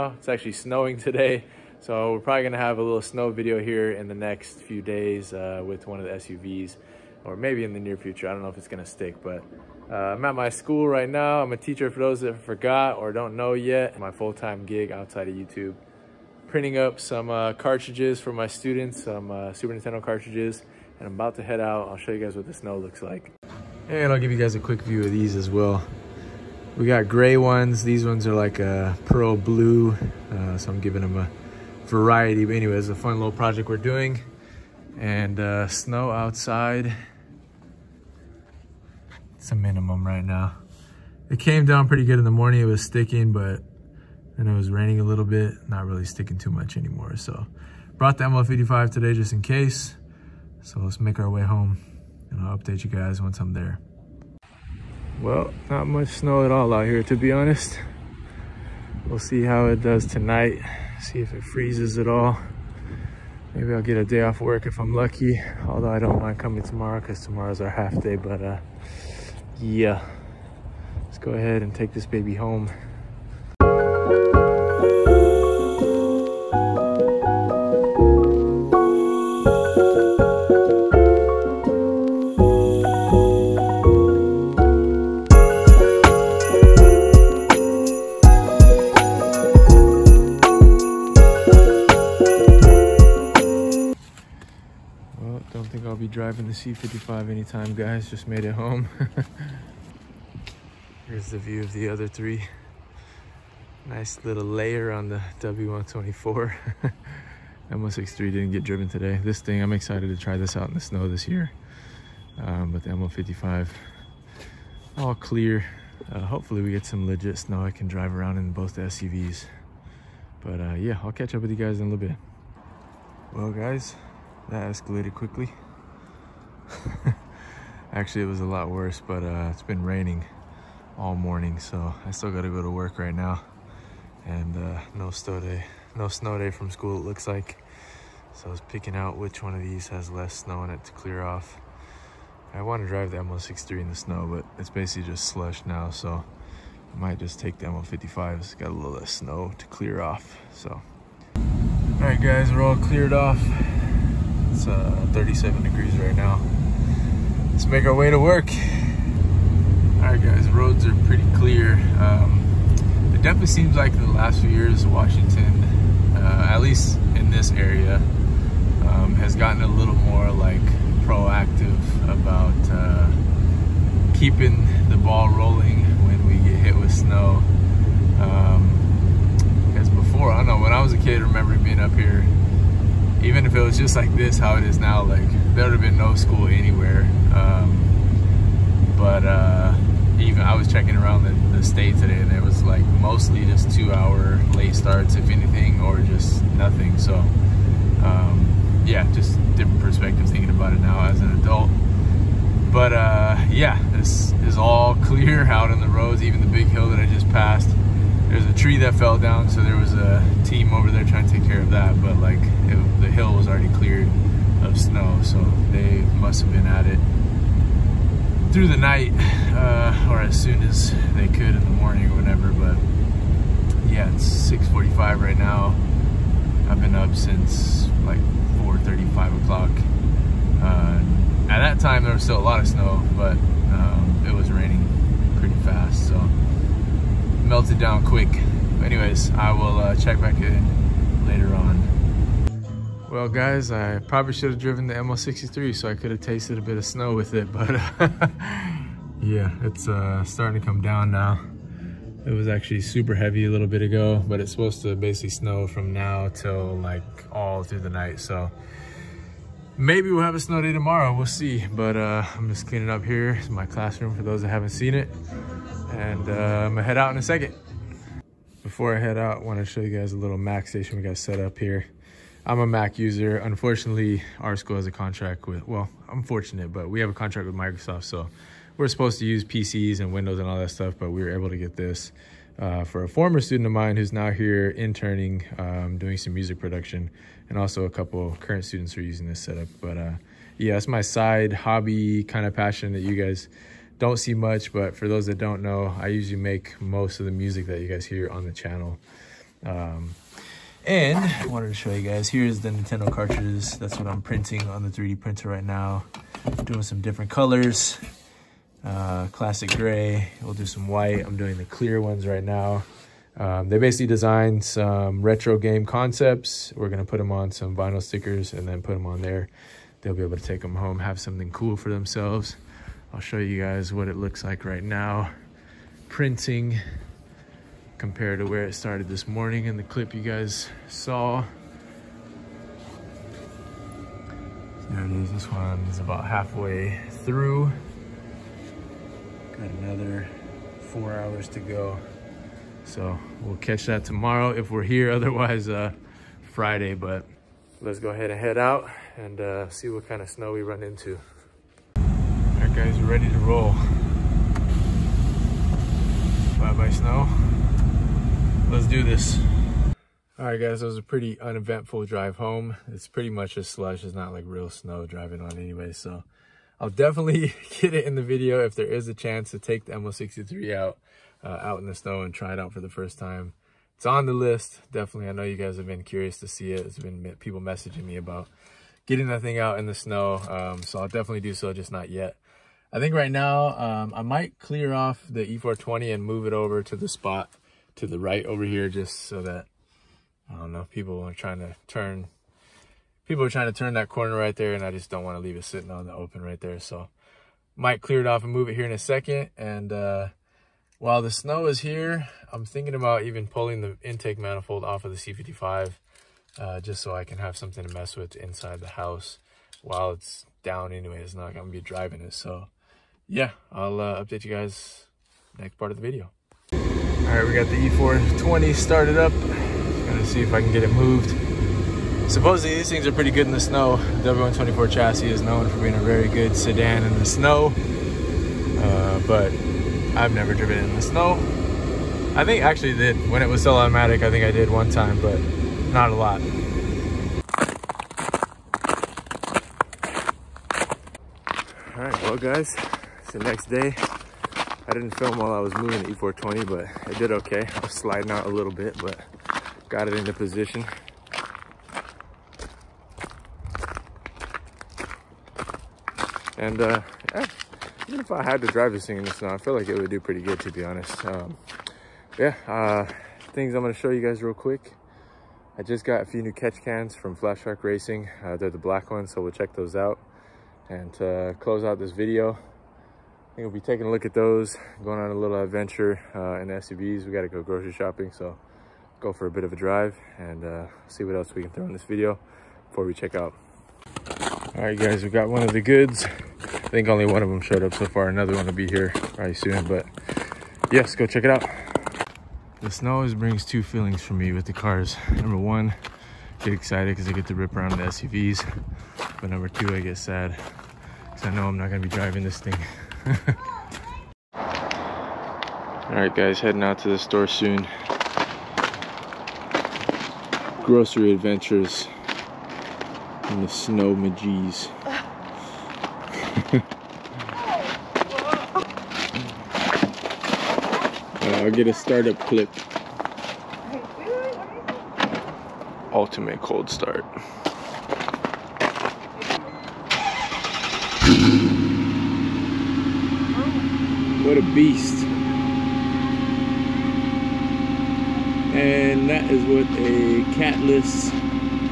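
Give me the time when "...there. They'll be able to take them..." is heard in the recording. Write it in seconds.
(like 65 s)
319 s.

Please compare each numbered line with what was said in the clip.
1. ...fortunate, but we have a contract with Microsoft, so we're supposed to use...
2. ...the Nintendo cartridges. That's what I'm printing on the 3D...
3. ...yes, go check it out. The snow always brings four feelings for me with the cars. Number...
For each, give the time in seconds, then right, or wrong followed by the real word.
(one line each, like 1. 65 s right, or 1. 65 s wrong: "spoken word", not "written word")
1. 276 s right
2. 302 s right
3. 490 s wrong: "two", not "four".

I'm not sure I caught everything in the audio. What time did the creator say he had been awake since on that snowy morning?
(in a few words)
4:35.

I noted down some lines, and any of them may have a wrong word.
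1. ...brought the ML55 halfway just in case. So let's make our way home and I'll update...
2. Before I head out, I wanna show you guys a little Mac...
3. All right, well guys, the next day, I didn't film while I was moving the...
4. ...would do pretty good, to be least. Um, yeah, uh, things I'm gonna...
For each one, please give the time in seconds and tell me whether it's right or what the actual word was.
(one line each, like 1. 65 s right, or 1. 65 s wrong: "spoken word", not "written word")
1. 47 s wrong: "today", not "halfway"
2. 268 s right
3. 441 s right
4. 460 s wrong: "honest", not "least".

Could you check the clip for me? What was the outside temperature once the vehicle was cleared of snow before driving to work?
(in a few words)
37 degrees.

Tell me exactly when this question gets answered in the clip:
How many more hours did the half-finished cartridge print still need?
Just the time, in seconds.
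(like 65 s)
340 s.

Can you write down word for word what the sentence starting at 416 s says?
All right, we got the E420 started up.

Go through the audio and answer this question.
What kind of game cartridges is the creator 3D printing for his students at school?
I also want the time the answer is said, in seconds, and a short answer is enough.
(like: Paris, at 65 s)
Super Nintendo, at 19 s.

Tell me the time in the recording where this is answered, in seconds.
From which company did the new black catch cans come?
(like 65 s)
467 s.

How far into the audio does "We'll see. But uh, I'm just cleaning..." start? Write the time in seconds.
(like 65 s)
261 s.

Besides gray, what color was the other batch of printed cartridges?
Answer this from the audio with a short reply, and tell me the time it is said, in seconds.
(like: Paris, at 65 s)
pearl blue, at 29 s.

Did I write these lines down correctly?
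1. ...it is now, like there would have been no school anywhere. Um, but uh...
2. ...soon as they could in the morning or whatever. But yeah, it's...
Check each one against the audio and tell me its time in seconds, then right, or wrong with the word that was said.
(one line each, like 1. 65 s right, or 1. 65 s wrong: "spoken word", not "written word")
1. 184 s right
2. 220 s right.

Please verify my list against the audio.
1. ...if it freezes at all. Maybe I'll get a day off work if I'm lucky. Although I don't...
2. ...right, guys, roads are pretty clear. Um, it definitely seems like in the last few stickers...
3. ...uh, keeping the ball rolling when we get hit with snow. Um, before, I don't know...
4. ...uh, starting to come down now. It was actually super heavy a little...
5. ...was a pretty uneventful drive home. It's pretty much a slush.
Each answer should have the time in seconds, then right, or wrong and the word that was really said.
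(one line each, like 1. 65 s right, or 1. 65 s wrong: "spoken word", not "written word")
1. 61 s right
2. 160 s wrong: "years", not "stickers"
3. 172 s right
4. 249 s right
5. 360 s right.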